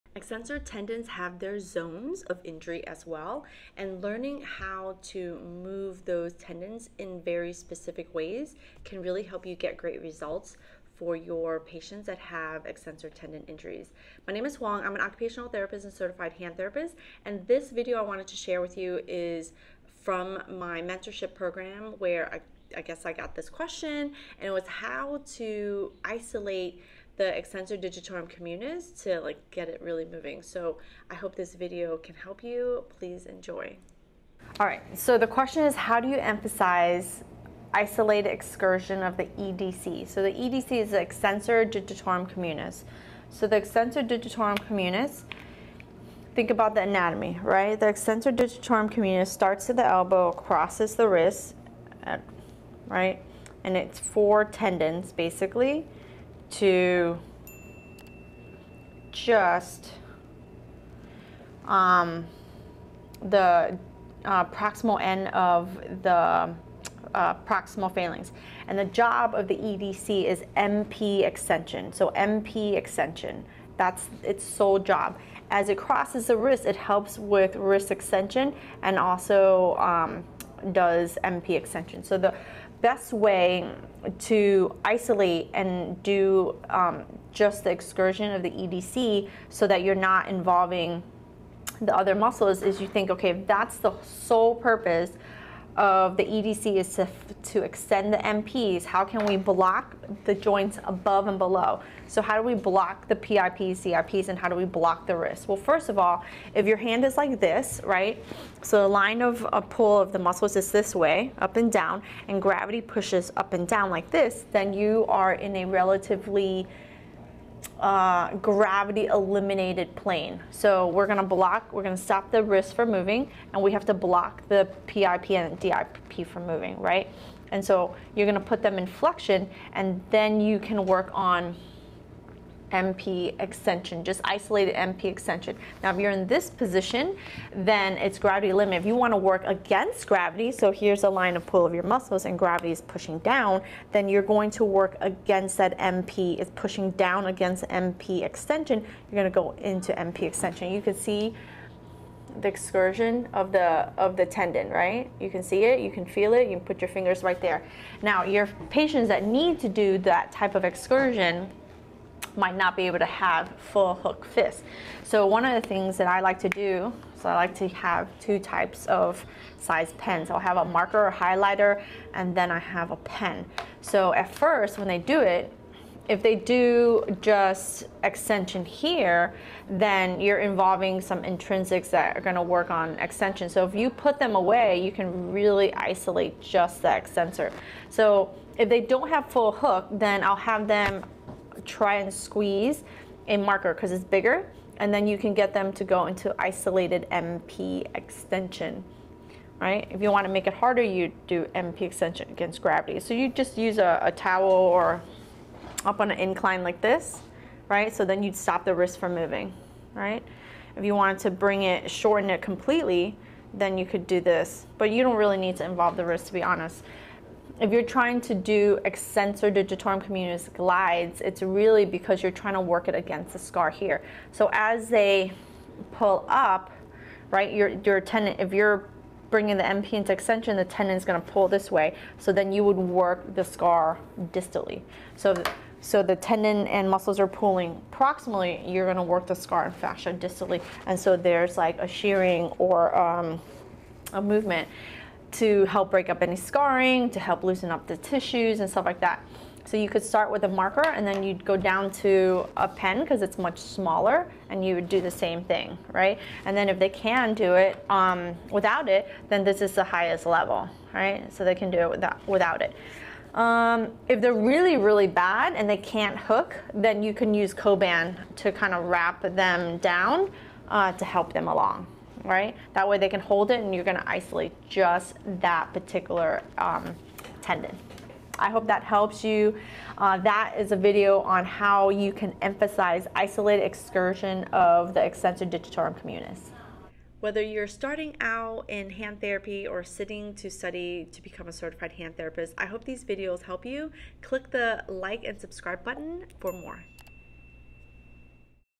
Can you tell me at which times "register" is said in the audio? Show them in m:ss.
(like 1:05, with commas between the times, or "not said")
not said.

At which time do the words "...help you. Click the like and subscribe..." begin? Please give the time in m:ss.
4:53.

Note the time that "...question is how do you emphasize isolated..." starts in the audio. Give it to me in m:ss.
0:35.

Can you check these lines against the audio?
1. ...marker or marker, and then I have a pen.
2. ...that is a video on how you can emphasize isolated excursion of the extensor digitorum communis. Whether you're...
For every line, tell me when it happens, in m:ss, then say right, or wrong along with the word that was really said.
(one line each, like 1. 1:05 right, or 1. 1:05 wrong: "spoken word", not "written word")
1. 2:50 wrong: "highlighter", not "marker"
2. 4:40 right.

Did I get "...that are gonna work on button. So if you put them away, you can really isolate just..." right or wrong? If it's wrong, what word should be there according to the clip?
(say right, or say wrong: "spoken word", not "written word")
wrong: "extension", not "button".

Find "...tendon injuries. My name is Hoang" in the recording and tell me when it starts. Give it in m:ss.
0:13.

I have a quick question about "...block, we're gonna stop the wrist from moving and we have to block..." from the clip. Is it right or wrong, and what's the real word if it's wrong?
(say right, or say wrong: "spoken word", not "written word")
right.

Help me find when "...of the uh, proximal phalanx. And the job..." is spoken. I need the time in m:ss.
1:05.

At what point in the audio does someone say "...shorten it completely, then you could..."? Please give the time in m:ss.
3:31.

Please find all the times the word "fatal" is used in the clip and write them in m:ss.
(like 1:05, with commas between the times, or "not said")
not said.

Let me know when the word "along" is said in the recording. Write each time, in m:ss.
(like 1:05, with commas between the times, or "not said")
4:31.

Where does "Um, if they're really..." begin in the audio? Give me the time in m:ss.
4:23.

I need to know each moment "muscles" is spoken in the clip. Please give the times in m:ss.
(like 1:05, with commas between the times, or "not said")
1:32, 1:50, 2:21, 3:56.